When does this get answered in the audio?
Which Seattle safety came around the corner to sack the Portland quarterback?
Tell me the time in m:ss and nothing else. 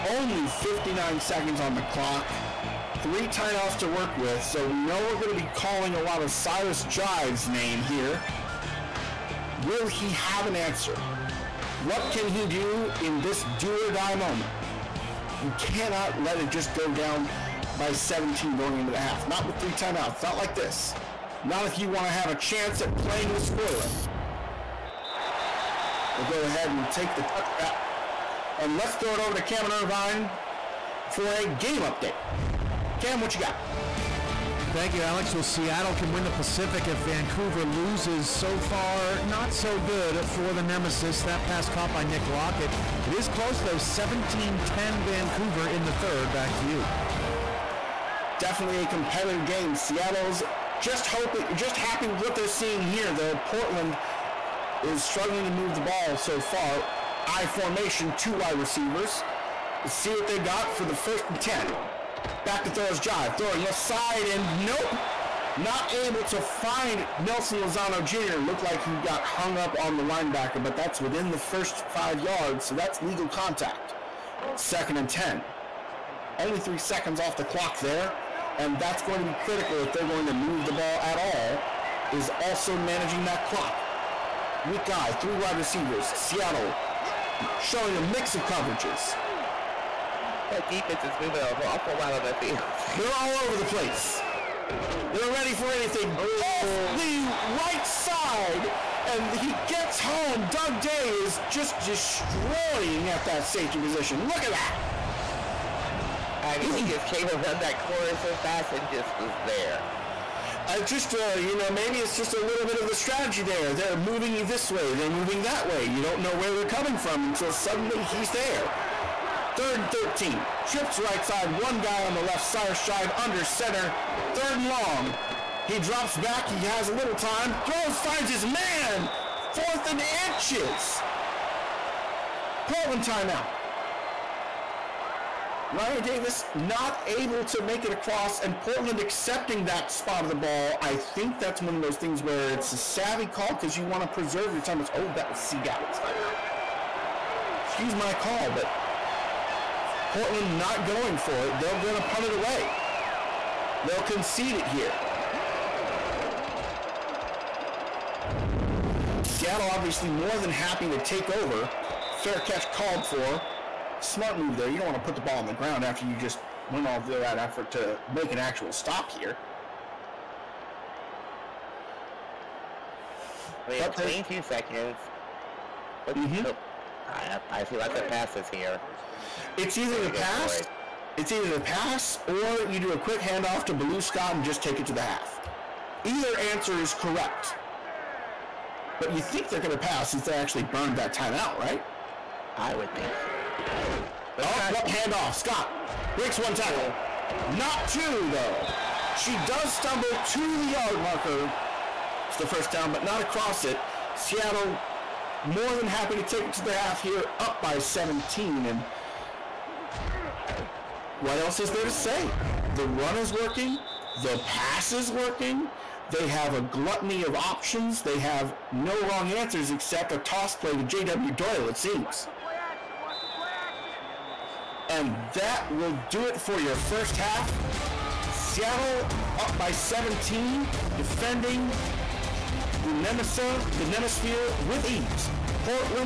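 1:40.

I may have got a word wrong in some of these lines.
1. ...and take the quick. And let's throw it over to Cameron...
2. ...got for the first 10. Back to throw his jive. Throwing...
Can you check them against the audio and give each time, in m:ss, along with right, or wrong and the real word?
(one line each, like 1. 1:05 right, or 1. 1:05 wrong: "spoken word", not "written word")
1. 0:26 wrong: "touchback", not "quick"
2. 1:00 right.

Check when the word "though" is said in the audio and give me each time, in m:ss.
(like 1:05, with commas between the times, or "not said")
0:43, 0:53, 3:18.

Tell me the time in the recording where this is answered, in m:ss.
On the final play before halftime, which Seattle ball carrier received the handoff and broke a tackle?
3:03.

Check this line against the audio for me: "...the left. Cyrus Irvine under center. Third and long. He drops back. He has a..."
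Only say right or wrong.
wrong.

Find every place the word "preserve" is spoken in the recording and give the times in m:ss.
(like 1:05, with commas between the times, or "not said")
2:24.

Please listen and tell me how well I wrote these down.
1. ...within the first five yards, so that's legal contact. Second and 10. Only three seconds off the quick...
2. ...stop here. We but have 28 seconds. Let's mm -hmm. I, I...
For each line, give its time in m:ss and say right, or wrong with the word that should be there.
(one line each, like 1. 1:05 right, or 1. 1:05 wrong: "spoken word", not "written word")
1. 1:11 wrong: "clock", not "quick"
2. 2:48 wrong: "22", not "28".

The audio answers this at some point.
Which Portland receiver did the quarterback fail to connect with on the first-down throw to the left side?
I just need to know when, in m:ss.
1:07.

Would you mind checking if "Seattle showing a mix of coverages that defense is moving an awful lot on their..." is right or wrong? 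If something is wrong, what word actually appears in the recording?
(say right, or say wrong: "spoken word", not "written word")
right.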